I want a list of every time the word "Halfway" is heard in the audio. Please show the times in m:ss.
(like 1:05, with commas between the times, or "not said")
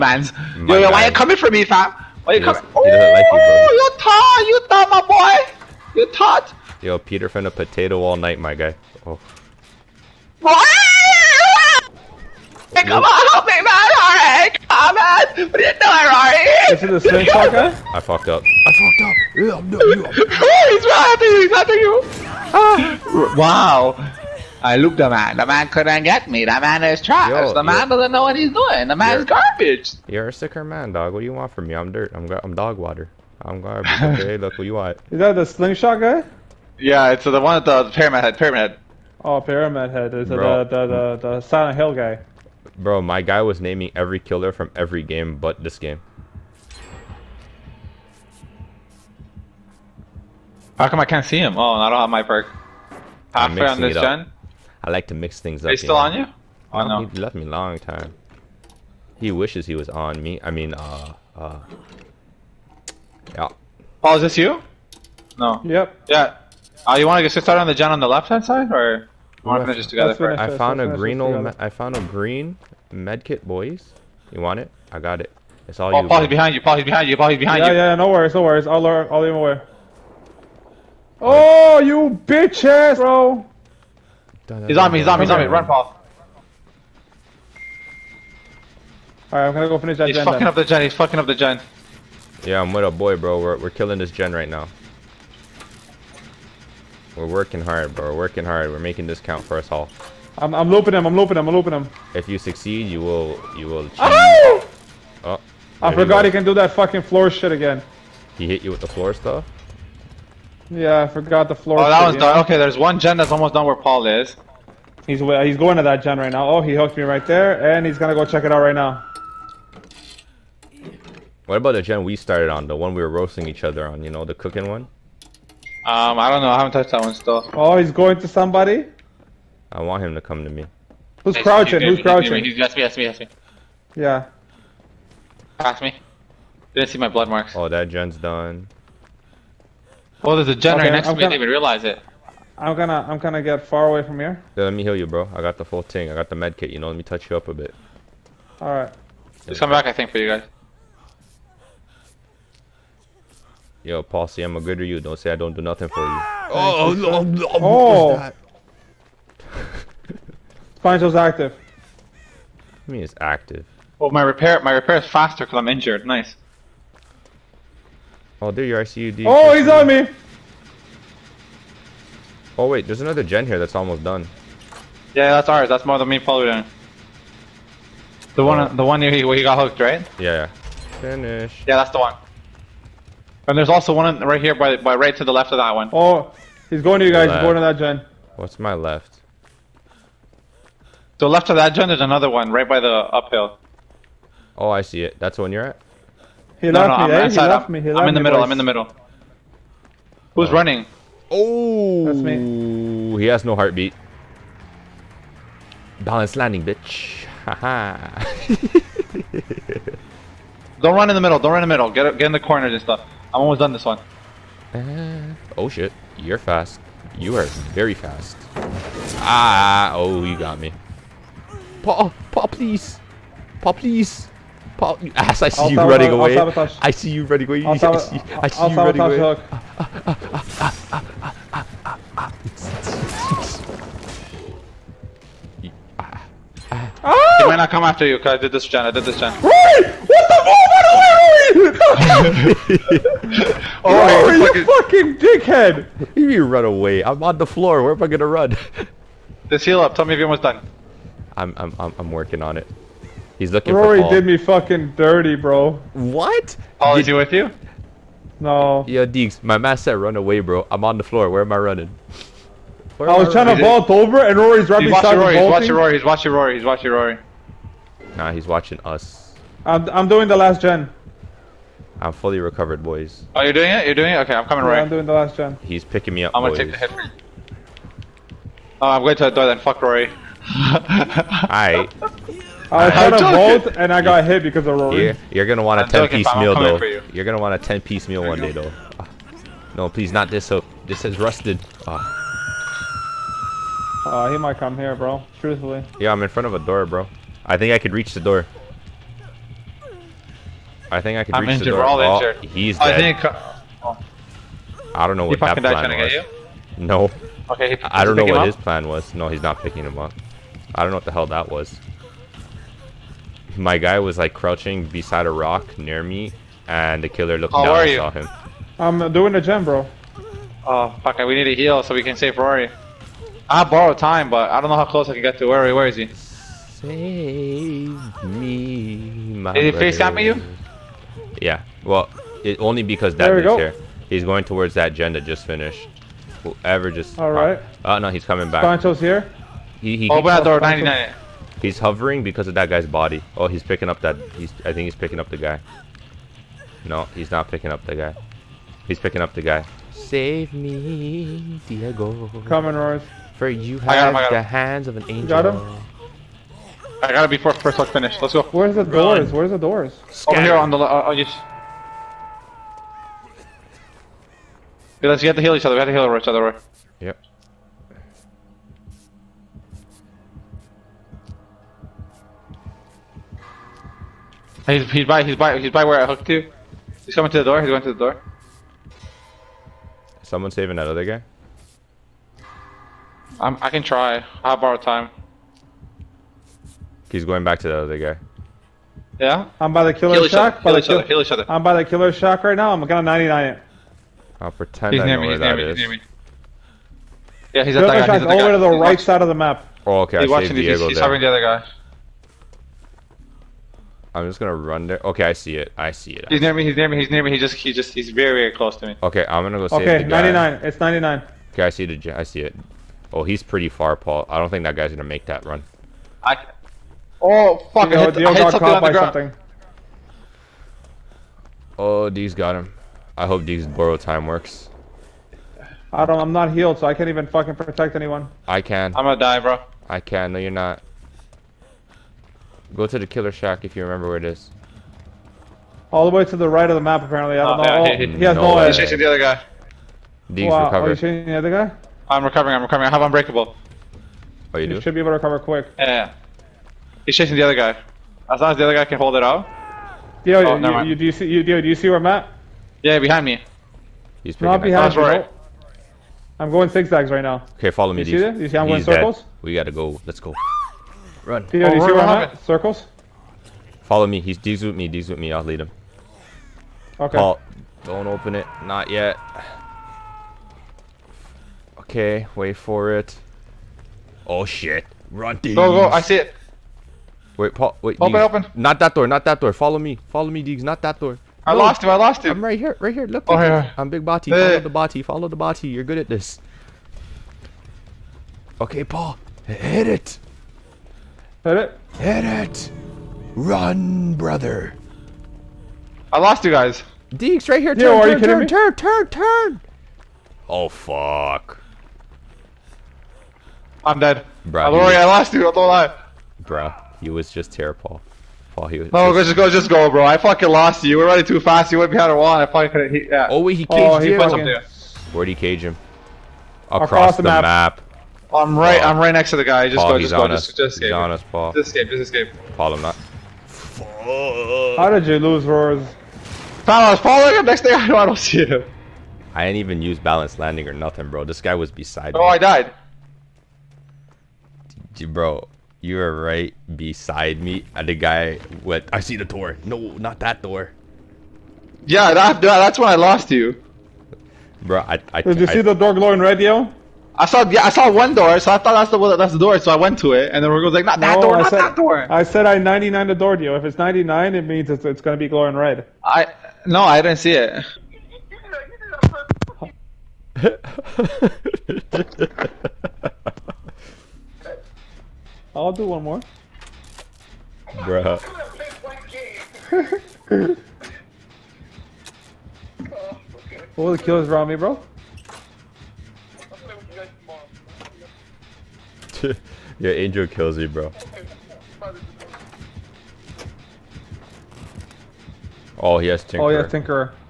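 0:53.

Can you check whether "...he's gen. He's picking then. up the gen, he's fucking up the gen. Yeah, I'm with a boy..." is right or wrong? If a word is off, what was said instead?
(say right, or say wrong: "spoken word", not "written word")
wrong: "fucking", not "picking".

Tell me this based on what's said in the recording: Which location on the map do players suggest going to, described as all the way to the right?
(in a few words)
Killer shack.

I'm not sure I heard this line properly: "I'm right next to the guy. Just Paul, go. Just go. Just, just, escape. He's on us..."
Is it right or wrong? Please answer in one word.
right.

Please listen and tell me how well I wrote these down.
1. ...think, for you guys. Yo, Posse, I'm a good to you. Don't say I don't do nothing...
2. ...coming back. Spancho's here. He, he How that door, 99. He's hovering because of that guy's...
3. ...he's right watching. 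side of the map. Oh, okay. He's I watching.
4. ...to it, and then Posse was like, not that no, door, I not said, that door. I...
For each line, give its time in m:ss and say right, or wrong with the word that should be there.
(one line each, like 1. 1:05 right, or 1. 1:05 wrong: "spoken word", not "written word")
1. 2:29 right
2. 5:38 wrong: "Open", not "How"
3. 6:38 right
4. 9:09 wrong: "Rodrigo", not "Posse".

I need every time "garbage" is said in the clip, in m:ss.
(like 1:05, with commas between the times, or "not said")
0:29, 0:33.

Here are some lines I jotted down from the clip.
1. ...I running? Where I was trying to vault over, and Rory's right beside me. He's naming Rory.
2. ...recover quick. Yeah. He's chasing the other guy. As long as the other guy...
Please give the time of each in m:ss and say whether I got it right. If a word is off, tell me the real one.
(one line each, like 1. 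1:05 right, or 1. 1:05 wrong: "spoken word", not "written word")
1. 4:21 wrong: "watching", not "naming"
2. 7:25 right.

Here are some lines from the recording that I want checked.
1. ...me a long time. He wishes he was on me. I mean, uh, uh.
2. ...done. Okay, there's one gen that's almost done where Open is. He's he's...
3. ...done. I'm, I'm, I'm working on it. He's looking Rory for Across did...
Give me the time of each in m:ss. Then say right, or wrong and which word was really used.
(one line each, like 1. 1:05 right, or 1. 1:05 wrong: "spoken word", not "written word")
1. 0:57 right
2. 1:52 wrong: "Paul", not "Open"
3. 4:10 wrong: "Rory", not "Across".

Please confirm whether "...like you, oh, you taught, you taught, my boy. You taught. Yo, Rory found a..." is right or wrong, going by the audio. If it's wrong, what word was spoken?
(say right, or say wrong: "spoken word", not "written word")
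wrong: "Peter", not "Rory".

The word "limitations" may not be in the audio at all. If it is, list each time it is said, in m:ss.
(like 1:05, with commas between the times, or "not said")
not said.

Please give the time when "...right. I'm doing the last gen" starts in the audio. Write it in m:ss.
4:34.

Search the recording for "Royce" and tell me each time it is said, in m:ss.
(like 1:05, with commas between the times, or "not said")
5:52.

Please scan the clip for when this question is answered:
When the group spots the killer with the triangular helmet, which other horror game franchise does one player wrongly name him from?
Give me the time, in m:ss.
0:41.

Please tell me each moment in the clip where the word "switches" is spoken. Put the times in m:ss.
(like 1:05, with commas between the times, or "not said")
not said.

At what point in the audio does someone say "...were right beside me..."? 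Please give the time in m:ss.
8:55.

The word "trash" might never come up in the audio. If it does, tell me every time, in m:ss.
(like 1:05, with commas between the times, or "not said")
0:27.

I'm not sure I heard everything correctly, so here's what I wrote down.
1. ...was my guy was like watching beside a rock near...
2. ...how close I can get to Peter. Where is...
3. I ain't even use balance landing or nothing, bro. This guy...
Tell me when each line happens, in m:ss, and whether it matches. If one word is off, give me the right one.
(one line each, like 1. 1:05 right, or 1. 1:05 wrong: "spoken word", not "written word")
1. 5:11 wrong: "crouching", not "watching"
2. 5:24 wrong: "Rory", not "Peter"
3. 8:49 right.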